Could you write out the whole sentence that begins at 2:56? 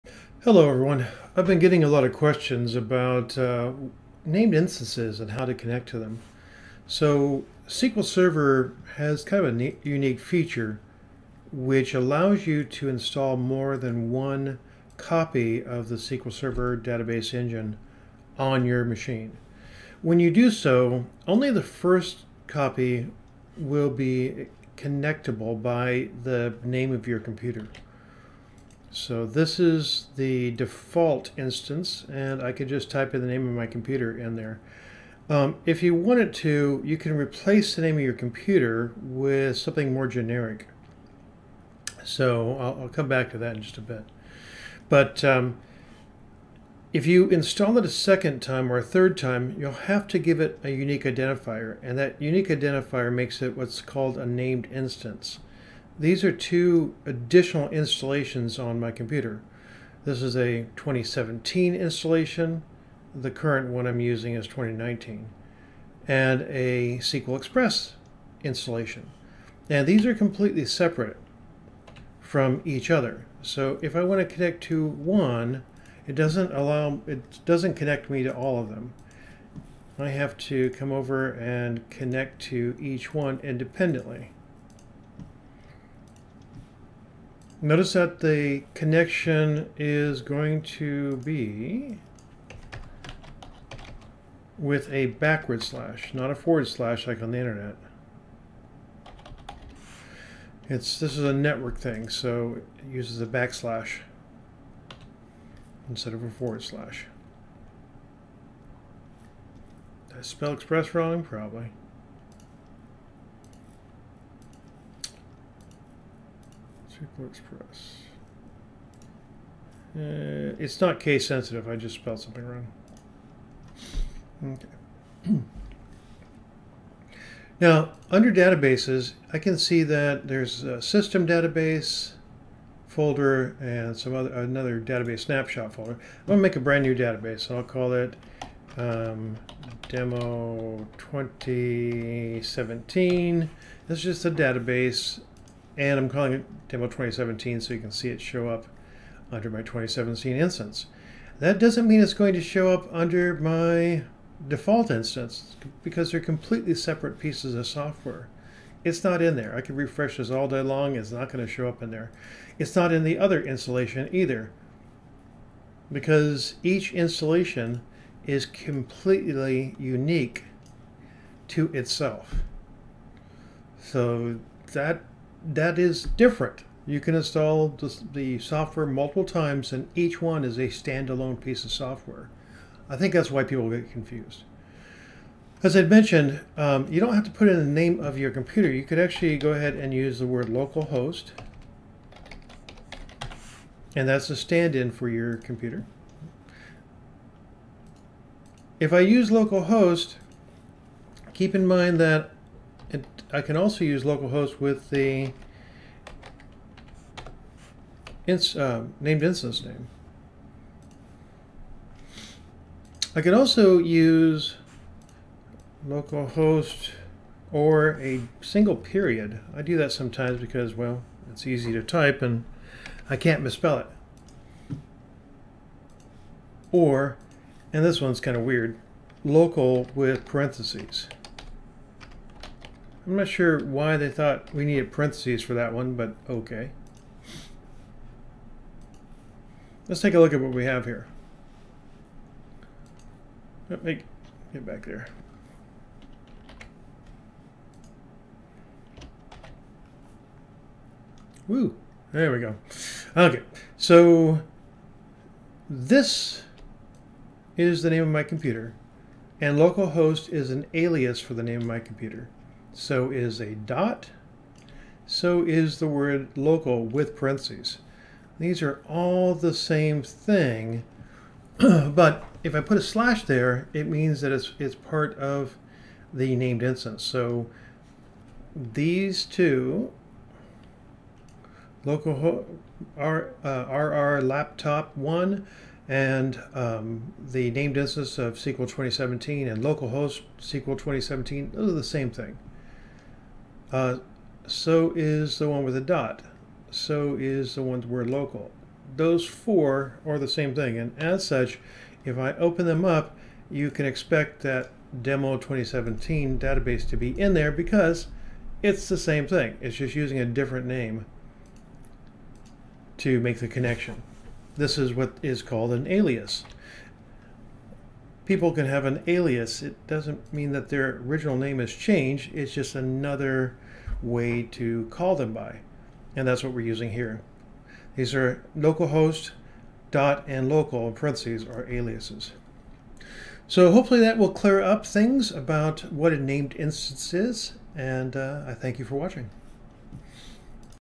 You can install the, software multiple times and each one is a standalone piece of software.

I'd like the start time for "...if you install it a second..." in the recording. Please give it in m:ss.
0:46.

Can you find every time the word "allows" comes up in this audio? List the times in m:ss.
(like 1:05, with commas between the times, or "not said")
0:11, 1:16.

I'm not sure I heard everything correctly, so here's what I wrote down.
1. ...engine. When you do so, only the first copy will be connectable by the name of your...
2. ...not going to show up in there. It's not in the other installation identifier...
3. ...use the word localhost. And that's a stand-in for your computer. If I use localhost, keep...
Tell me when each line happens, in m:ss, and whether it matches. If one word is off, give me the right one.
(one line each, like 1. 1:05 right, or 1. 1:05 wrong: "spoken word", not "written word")
1. 0:18 wrong: "machine", not "engine"
2. 2:41 wrong: "either", not "identifier"
3. 3:09 right.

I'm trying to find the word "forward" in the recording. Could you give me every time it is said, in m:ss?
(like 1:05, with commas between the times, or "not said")
1:36, 1:46.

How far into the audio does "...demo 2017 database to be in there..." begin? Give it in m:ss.
5:05.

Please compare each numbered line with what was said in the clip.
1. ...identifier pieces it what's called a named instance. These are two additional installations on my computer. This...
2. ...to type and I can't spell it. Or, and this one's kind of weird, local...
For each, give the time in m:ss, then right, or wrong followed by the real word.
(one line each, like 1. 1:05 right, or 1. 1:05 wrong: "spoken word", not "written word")
1. 0:52 wrong: "makes", not "pieces"
2. 3:41 wrong: "misspell", not "spell".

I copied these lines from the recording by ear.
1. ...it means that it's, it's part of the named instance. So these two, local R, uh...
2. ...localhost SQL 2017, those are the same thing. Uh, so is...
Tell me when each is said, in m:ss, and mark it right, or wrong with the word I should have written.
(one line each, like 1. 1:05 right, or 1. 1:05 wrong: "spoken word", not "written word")
1. 4:33 right
2. 4:49 right.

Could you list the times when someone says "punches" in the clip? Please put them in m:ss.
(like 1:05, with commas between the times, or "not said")
not said.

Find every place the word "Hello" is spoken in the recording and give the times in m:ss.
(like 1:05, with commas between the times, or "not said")
0:00.